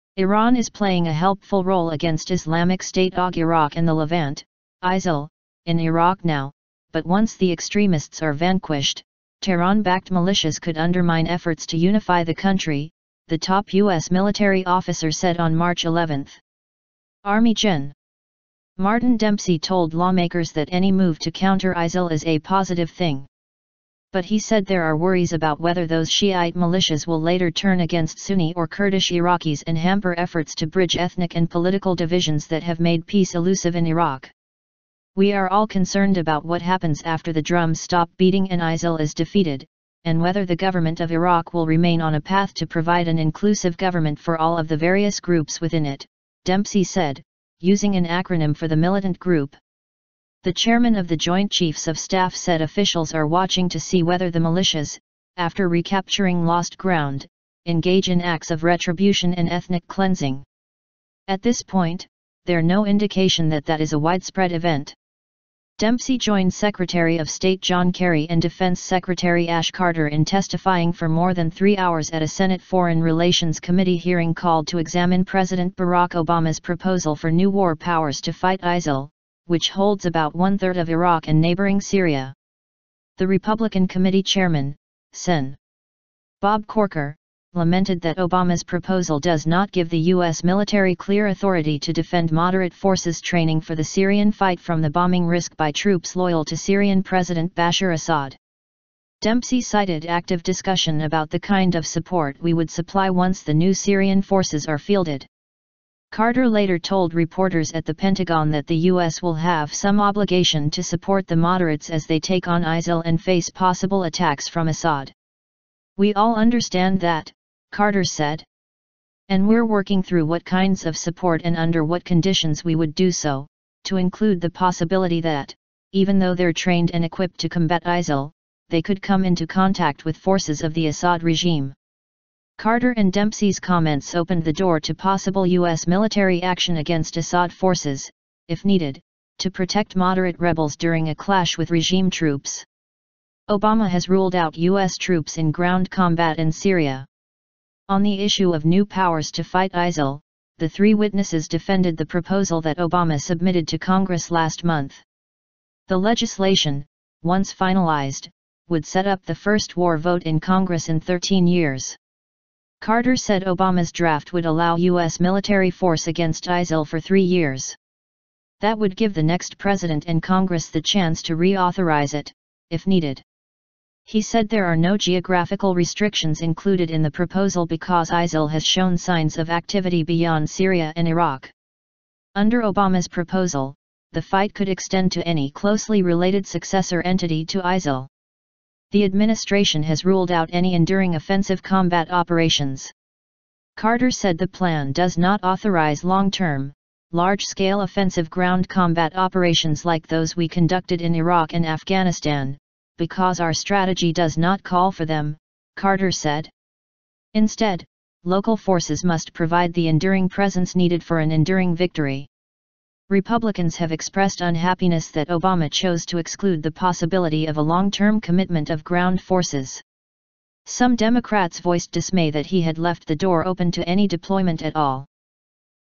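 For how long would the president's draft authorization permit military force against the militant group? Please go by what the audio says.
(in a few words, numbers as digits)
3 years.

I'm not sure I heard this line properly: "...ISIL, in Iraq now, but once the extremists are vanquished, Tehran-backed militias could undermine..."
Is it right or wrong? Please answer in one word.
right.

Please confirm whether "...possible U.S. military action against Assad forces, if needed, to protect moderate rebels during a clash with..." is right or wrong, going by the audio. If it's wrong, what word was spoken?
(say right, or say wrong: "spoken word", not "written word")
right.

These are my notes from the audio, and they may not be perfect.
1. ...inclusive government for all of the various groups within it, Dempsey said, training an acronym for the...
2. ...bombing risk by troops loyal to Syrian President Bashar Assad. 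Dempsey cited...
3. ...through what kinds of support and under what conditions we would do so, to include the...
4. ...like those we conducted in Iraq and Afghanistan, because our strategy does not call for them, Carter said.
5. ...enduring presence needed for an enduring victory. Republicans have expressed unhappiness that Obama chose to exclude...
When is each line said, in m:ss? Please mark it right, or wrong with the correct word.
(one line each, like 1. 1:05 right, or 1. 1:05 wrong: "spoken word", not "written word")
1. 0:43 wrong: "using", not "training"
2. 1:34 right
3. 2:00 right
4. 3:19 right
5. 3:29 right.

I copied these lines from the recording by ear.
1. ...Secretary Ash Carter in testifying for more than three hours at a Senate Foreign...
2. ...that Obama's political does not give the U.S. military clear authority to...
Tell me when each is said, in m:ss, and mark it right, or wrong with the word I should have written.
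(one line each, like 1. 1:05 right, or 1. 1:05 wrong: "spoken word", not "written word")
1. 1:08 right
2. 1:27 wrong: "proposal", not "political".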